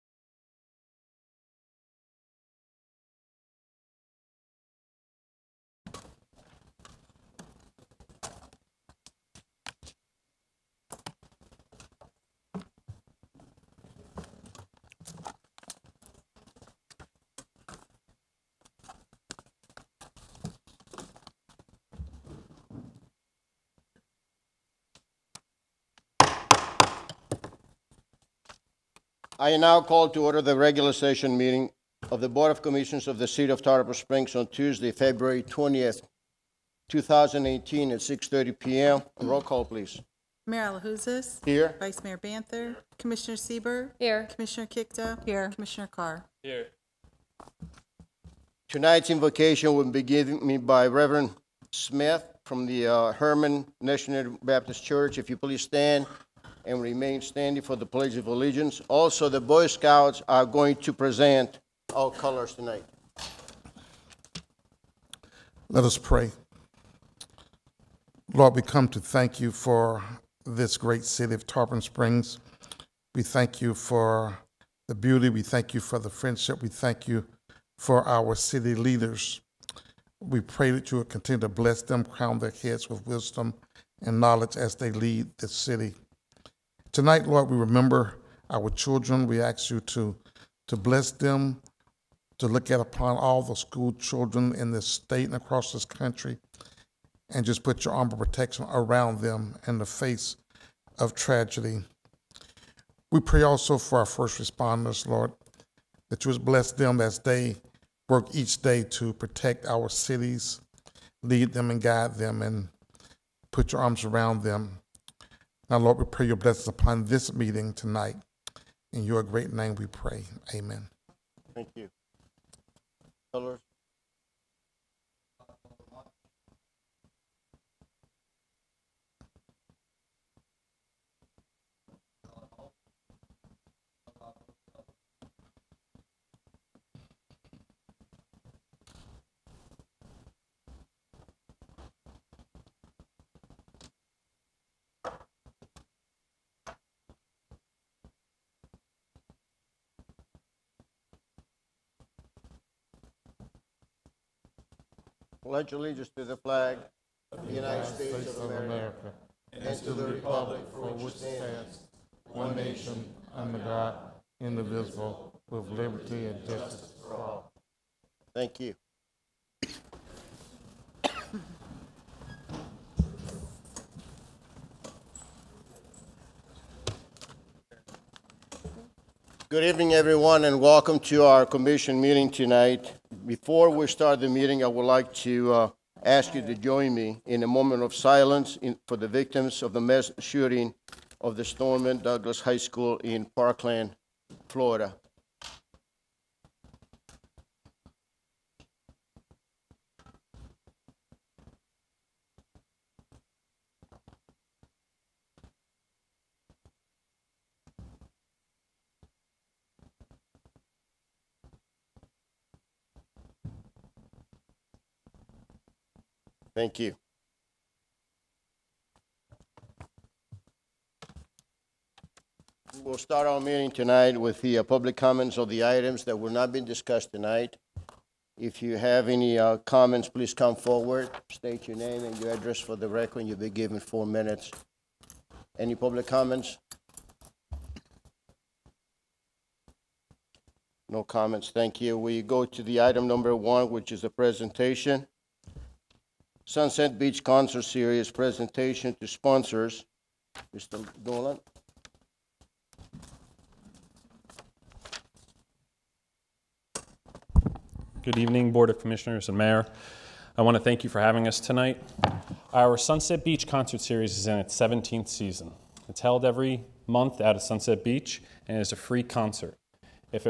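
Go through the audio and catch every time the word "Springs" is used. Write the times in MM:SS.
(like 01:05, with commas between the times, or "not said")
00:33, 01:11.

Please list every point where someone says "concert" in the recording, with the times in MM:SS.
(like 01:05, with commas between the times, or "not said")
04:07, 04:23, 04:29.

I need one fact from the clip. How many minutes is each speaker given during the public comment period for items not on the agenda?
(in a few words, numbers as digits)
4.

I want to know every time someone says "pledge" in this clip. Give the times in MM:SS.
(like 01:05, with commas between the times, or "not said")
00:57, 02:35.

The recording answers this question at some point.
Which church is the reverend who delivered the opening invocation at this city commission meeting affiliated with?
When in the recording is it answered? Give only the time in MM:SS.
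00:53.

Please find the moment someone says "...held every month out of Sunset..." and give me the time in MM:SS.
04:26.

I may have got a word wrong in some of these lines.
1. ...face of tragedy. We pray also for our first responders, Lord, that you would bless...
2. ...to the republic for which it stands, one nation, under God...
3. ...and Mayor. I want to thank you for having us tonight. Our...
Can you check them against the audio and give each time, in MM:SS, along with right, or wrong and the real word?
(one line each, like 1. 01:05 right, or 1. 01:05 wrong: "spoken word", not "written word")
1. 01:39 right
2. 02:39 right
3. 04:19 right.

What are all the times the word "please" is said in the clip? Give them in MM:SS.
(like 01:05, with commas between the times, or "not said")
00:39, 00:55, 03:50.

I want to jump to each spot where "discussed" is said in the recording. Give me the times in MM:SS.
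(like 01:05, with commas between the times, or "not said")
03:46.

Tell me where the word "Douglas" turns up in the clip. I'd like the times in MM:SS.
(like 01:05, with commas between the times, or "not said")
03:11.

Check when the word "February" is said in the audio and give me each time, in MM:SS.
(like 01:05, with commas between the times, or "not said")
00:34.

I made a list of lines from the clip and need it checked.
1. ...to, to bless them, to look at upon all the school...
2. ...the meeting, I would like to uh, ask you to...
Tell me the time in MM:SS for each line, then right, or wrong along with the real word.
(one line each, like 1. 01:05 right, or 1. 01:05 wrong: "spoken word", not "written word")
1. 01:29 right
2. 03:04 right.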